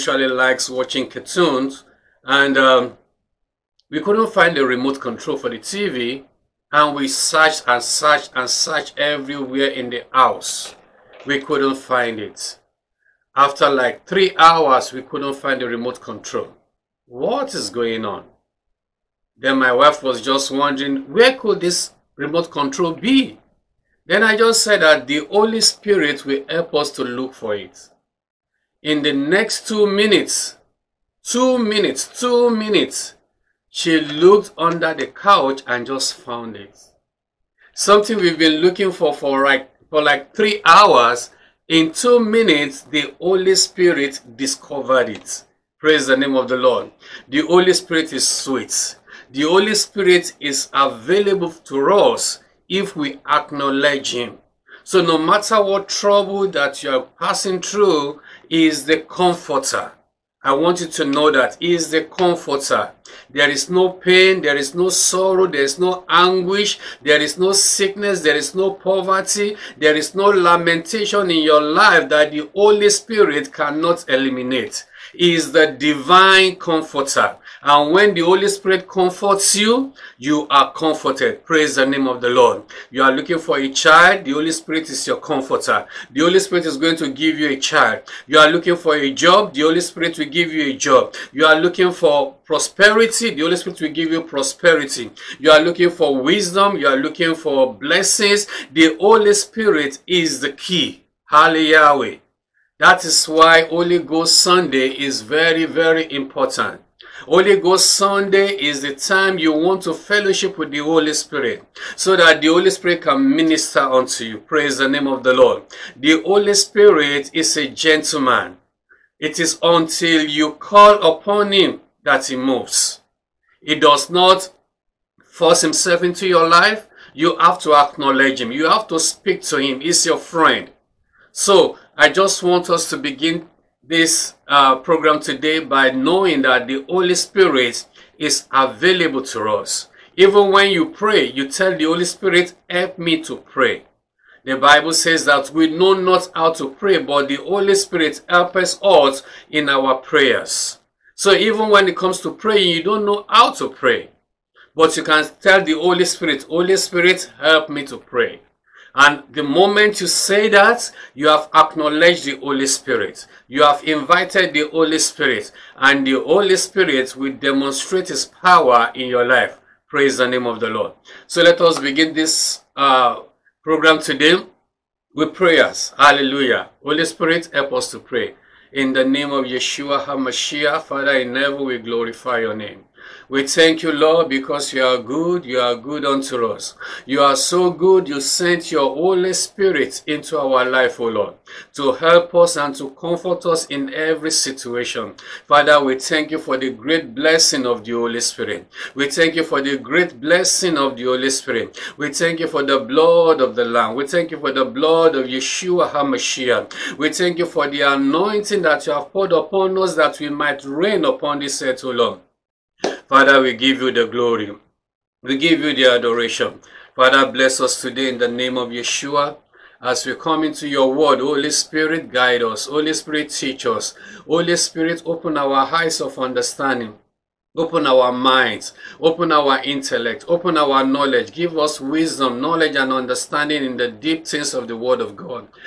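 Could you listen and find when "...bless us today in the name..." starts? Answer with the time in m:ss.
3:37.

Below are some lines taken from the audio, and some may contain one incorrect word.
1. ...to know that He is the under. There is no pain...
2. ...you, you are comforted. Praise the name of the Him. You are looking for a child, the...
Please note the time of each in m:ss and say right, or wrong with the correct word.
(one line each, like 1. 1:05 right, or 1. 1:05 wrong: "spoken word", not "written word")
1. 1:00 wrong: "comforter", not "under"
2. 1:19 wrong: "Lord", not "Him".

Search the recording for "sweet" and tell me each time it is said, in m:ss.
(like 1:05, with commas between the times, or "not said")
0:48.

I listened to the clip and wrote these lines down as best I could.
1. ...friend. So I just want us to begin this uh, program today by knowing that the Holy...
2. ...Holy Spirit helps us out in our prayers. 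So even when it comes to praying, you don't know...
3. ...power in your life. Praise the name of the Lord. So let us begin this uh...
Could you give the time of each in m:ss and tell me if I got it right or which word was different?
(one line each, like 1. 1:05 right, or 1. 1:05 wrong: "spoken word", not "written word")
1. 2:10 right
2. 2:27 right
3. 2:48 right.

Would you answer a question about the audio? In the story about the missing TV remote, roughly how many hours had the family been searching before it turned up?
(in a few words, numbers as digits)
3 hours.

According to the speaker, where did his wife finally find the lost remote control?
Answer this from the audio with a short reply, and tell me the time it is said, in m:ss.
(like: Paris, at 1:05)
Under the couch, at 0:34.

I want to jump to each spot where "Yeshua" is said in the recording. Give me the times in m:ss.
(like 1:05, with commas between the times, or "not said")
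2:59, 3:25, 3:38.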